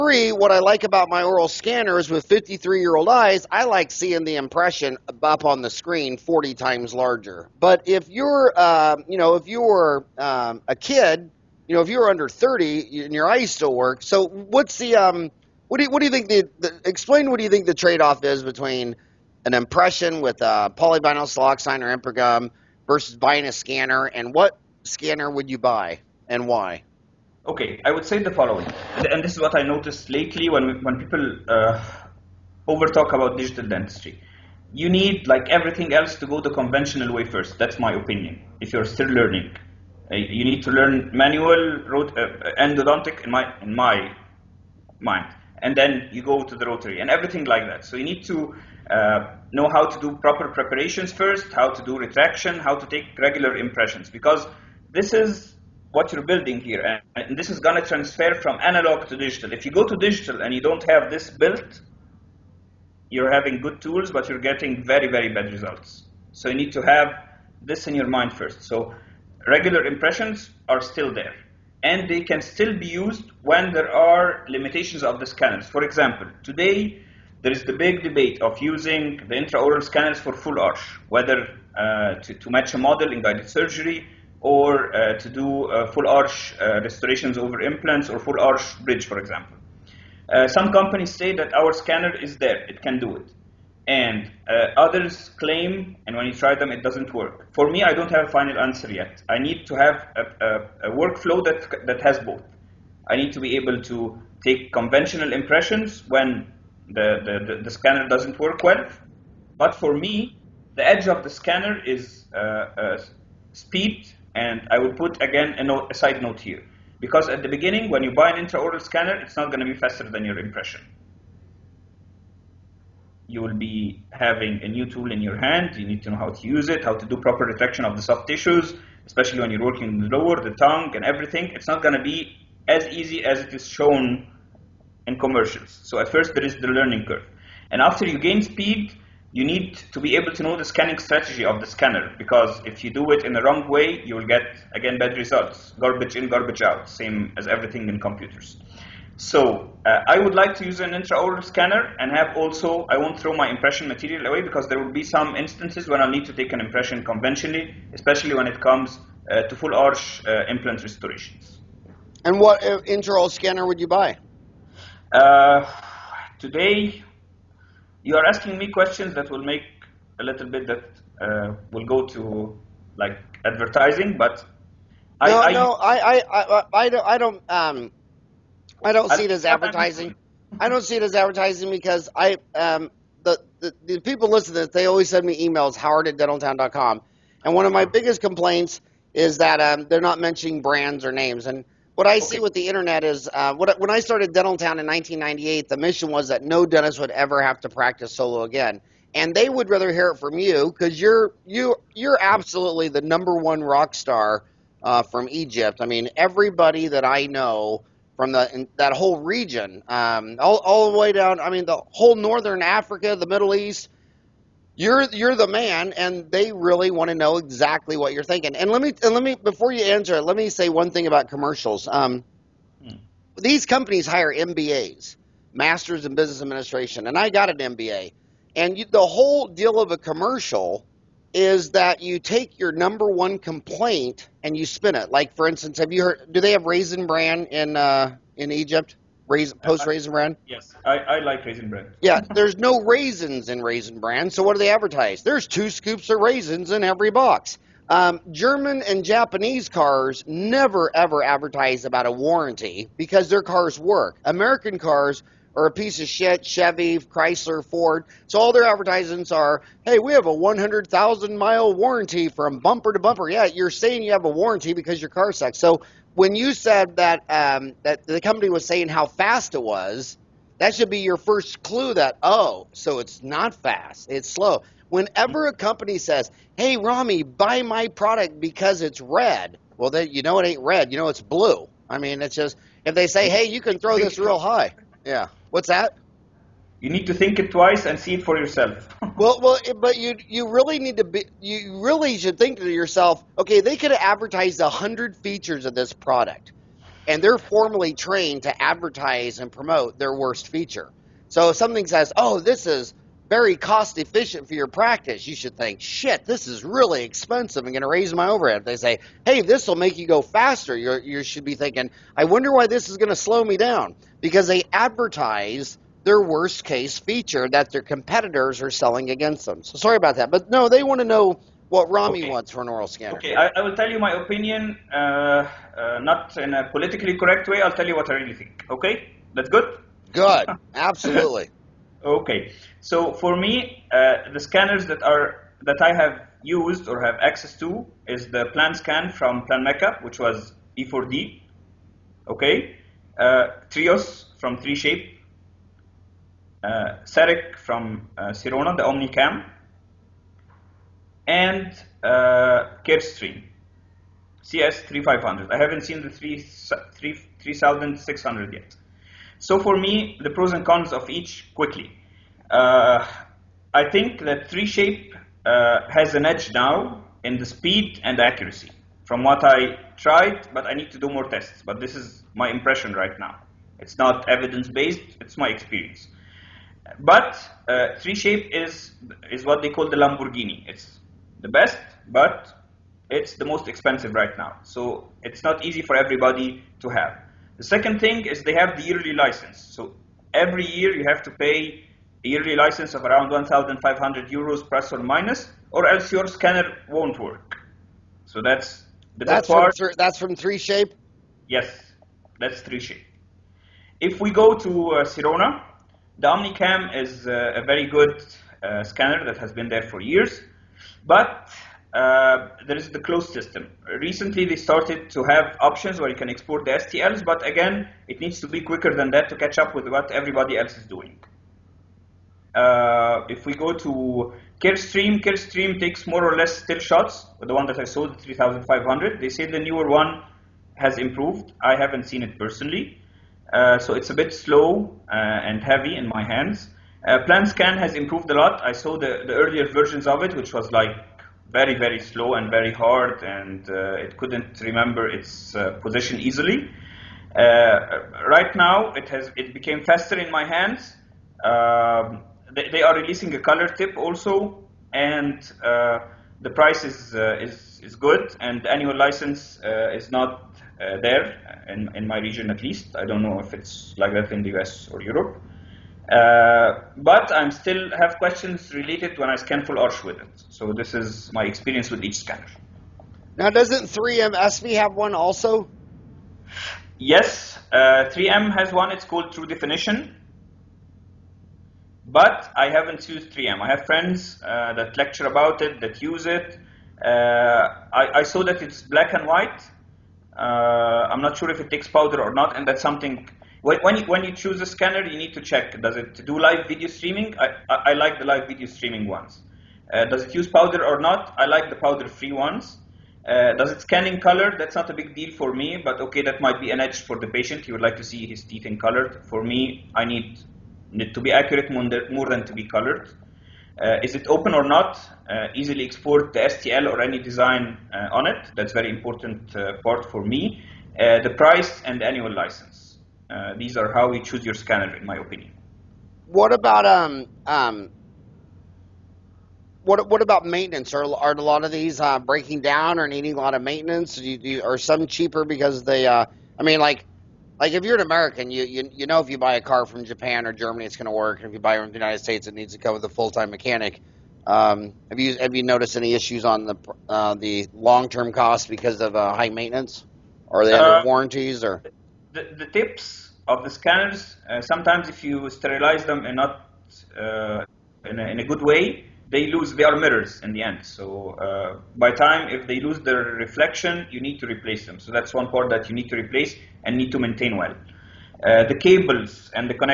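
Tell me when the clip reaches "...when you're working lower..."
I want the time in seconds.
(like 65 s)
129 s.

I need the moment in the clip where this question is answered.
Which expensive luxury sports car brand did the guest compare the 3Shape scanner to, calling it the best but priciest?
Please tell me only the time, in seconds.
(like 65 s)
379 s.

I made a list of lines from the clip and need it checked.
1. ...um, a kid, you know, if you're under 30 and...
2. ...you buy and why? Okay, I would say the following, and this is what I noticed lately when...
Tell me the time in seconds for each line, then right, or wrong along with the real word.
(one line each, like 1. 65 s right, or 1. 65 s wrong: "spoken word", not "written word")
1. 10 s right
2. 25 s right.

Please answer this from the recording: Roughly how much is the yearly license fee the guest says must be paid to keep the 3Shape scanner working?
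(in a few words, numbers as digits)
1,500 euros.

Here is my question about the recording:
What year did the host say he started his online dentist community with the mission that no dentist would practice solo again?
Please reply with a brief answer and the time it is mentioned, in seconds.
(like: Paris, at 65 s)
1998, at 194 s.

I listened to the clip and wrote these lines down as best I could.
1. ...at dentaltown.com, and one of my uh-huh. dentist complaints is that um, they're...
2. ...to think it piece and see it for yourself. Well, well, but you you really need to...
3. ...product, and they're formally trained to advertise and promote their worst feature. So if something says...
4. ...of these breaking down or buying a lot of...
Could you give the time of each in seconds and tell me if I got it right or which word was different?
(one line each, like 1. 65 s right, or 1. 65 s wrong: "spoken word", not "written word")
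1. 186 s wrong: "biggest", not "dentist"
2. 287 s wrong: "twice", not "piece"
3. 295 s right
4. 531 s wrong: "needing", not "buying".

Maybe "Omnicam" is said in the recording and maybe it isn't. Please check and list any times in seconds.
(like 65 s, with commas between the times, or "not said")
348 s, 406 s.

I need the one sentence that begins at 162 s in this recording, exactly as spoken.
And what uh, intraoral scanner would you buy?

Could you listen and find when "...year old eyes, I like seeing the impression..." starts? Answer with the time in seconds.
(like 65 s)
2 s.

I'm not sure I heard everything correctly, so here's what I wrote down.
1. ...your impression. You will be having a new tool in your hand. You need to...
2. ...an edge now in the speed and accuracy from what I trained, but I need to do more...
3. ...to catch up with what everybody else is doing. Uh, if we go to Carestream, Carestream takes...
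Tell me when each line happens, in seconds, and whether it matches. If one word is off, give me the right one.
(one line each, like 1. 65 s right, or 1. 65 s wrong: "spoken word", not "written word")
1. 120 s right
2. 366 s wrong: "tried", not "trained"
3. 419 s right.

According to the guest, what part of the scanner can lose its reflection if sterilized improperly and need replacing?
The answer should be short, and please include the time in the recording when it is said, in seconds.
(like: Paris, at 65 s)
tips, at 552 s.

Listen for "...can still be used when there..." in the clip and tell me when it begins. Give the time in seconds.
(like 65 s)
72 s.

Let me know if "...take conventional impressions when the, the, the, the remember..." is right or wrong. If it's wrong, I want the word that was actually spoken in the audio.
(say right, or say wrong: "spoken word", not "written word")
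wrong: "scanner", not "remember".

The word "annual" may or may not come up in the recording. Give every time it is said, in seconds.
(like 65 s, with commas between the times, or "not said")
458 s, 522 s.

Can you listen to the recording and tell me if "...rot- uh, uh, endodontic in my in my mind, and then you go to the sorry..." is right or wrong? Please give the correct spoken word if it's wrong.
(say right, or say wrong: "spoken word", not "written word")
wrong: "rotary", not "sorry".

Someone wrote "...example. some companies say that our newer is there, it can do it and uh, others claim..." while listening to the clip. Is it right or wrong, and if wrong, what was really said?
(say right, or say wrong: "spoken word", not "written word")
wrong: "scanner", not "newer".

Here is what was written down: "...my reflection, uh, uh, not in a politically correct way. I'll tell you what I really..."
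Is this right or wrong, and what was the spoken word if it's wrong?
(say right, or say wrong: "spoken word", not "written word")
wrong: "opinion", not "reflection".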